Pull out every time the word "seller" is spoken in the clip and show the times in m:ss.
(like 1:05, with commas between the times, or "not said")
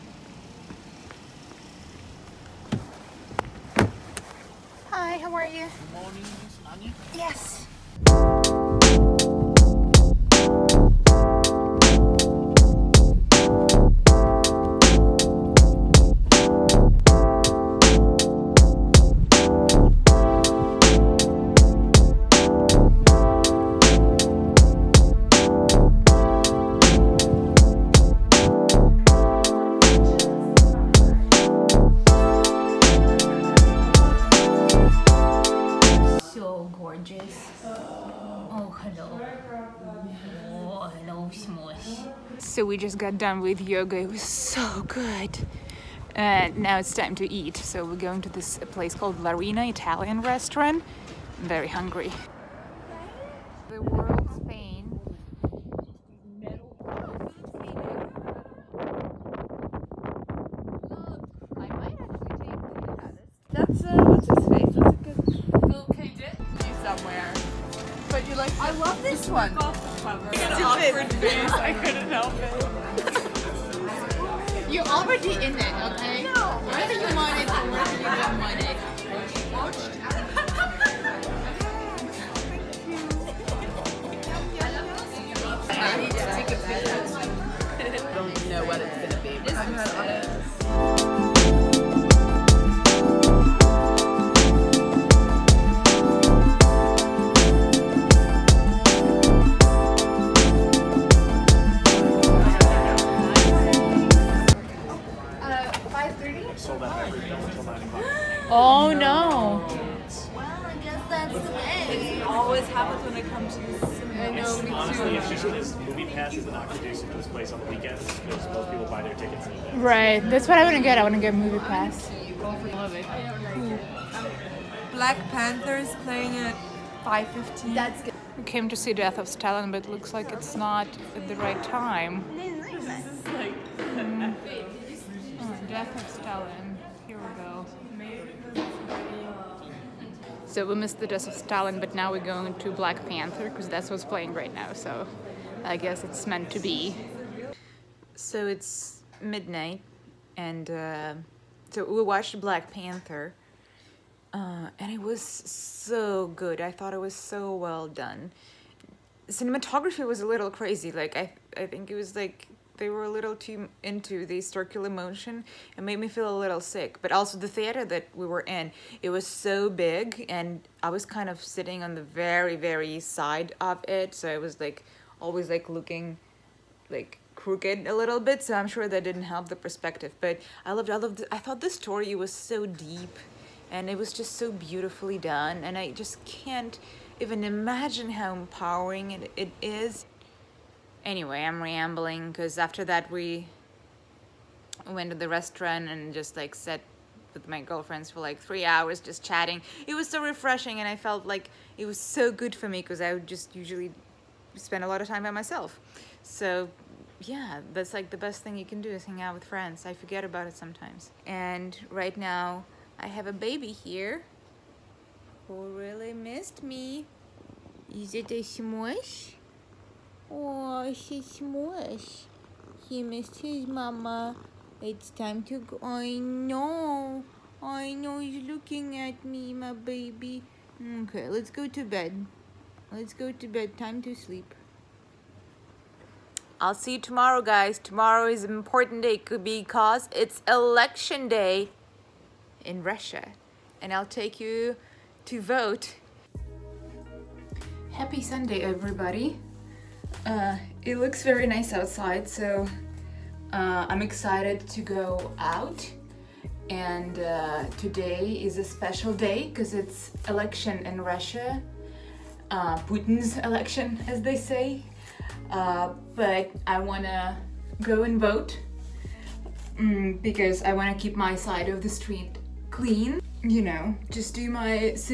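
not said.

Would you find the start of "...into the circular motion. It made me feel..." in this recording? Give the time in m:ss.
2:43.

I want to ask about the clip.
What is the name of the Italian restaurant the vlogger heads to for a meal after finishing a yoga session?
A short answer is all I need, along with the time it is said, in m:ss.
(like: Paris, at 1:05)
Larina, at 0:49.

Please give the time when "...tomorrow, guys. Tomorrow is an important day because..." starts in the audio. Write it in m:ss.
3:56.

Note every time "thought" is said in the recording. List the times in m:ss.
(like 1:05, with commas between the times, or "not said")
2:36, 3:01.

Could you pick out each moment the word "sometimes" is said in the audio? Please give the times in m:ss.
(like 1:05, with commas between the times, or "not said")
3:30.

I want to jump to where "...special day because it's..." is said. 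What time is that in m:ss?
4:18.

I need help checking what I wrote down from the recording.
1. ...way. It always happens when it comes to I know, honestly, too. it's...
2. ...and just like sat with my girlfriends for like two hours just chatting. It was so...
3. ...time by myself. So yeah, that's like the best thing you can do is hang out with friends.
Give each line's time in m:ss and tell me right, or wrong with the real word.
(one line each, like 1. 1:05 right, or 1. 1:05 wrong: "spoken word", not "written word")
1. 1:51 right
2. 3:15 wrong: "three", not "two"
3. 3:25 right.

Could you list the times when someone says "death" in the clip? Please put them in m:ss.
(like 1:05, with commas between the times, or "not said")
2:08, 2:15, 2:21.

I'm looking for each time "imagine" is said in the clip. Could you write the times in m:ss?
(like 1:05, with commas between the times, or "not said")
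3:07.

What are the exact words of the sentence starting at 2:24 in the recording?
So I guess it's meant to be.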